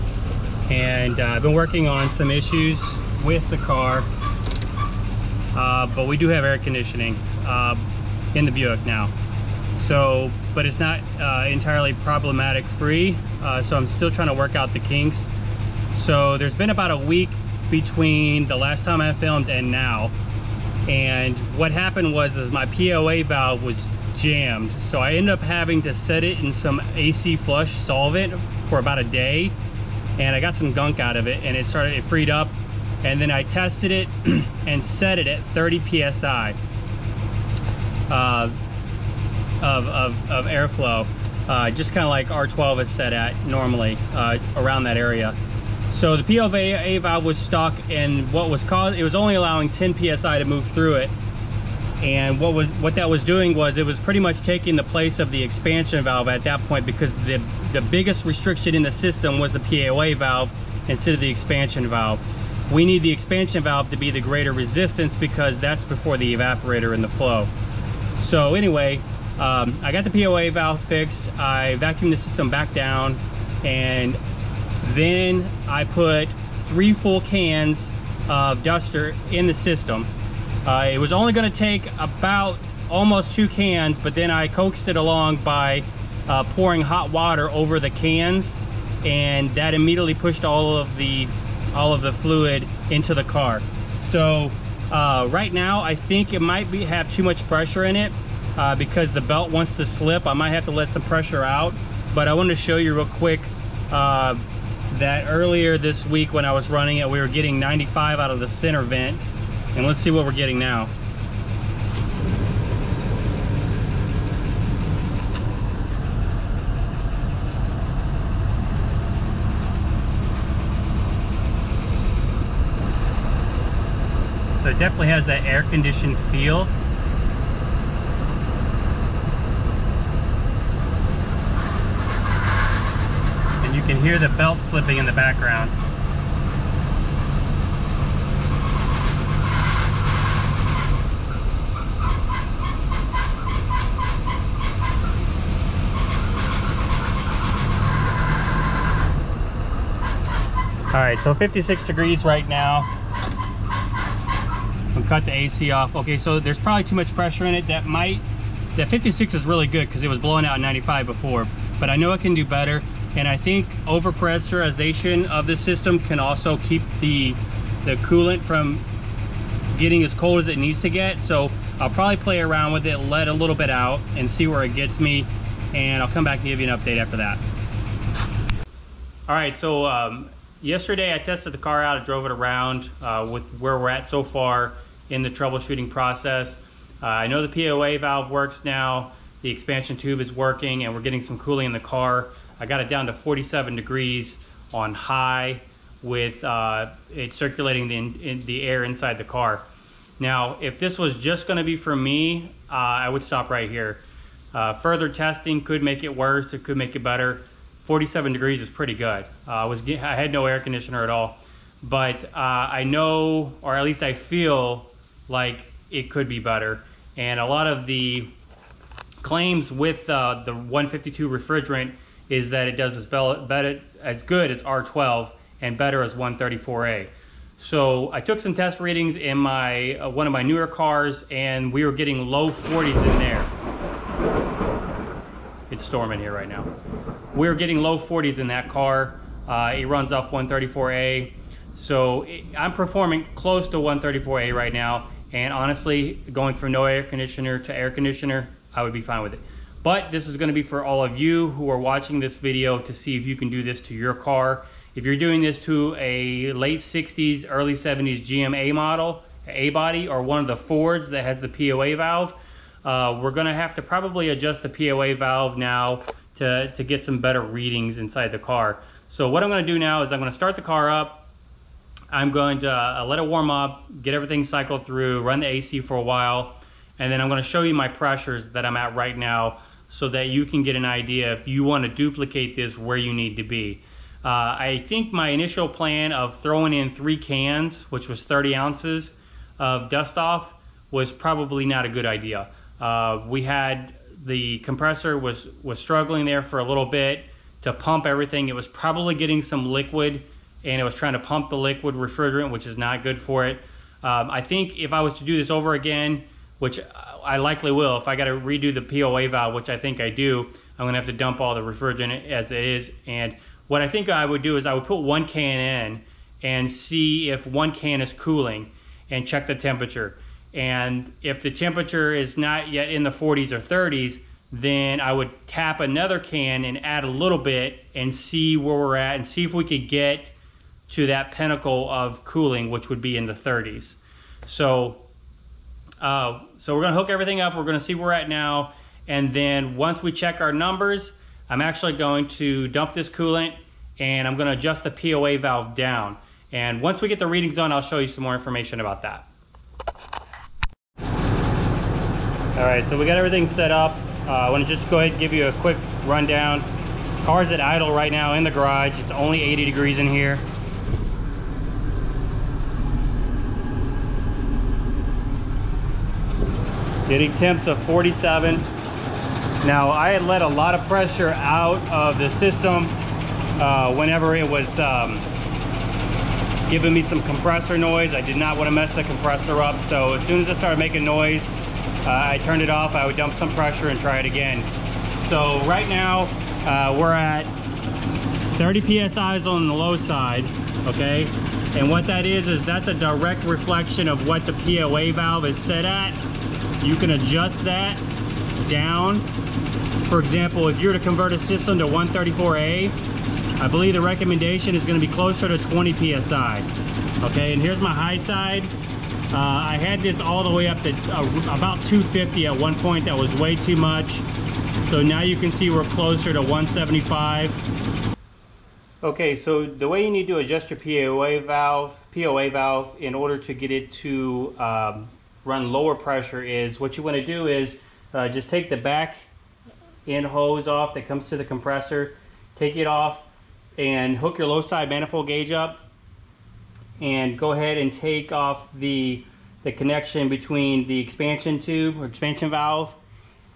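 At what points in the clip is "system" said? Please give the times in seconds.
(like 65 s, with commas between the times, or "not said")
58 s, 72 s, 79 s, 165 s, 372 s, 401 s.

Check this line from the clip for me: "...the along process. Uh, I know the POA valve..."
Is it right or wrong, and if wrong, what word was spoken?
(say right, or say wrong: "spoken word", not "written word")
wrong: "troubleshooting", not "along".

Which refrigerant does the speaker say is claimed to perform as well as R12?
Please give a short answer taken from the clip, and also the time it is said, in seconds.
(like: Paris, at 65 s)
152, at 220 s.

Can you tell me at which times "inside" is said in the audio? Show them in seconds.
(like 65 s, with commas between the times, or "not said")
198 s, 267 s.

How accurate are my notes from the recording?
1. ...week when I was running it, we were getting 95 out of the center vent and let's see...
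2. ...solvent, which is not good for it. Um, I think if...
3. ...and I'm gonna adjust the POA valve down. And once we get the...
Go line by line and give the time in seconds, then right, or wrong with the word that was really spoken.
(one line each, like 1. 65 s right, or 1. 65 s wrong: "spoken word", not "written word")
1. 106 s right
2. 301 s wrong: "refrigerant", not "solvent"
3. 343 s right.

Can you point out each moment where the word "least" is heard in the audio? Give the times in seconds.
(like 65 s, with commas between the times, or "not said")
213 s.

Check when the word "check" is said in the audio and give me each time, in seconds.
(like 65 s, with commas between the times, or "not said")
319 s, 340 s.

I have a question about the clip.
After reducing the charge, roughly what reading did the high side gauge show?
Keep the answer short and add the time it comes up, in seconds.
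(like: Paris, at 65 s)
175, at 416 s.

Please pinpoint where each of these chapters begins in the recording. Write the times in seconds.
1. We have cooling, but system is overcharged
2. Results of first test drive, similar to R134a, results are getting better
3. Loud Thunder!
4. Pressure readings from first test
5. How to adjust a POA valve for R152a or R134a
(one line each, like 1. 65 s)
1. 111 s
2. 176 s
3. 229 s
4. 351 s
5. 417 s.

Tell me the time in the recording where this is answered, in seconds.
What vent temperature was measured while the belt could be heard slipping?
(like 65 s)
151 s.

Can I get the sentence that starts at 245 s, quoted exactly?
And honestly, going from no air conditioner to air conditioner, I would be fine with it.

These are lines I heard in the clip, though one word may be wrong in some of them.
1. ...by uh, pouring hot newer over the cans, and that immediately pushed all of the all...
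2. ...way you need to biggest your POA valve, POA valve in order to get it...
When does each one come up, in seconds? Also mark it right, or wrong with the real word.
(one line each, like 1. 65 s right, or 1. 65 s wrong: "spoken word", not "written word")
1. 85 s wrong: "water", not "newer"
2. 419 s wrong: "adjust", not "biggest".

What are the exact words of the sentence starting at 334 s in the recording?
So, uh, so we're gonna hook everything up.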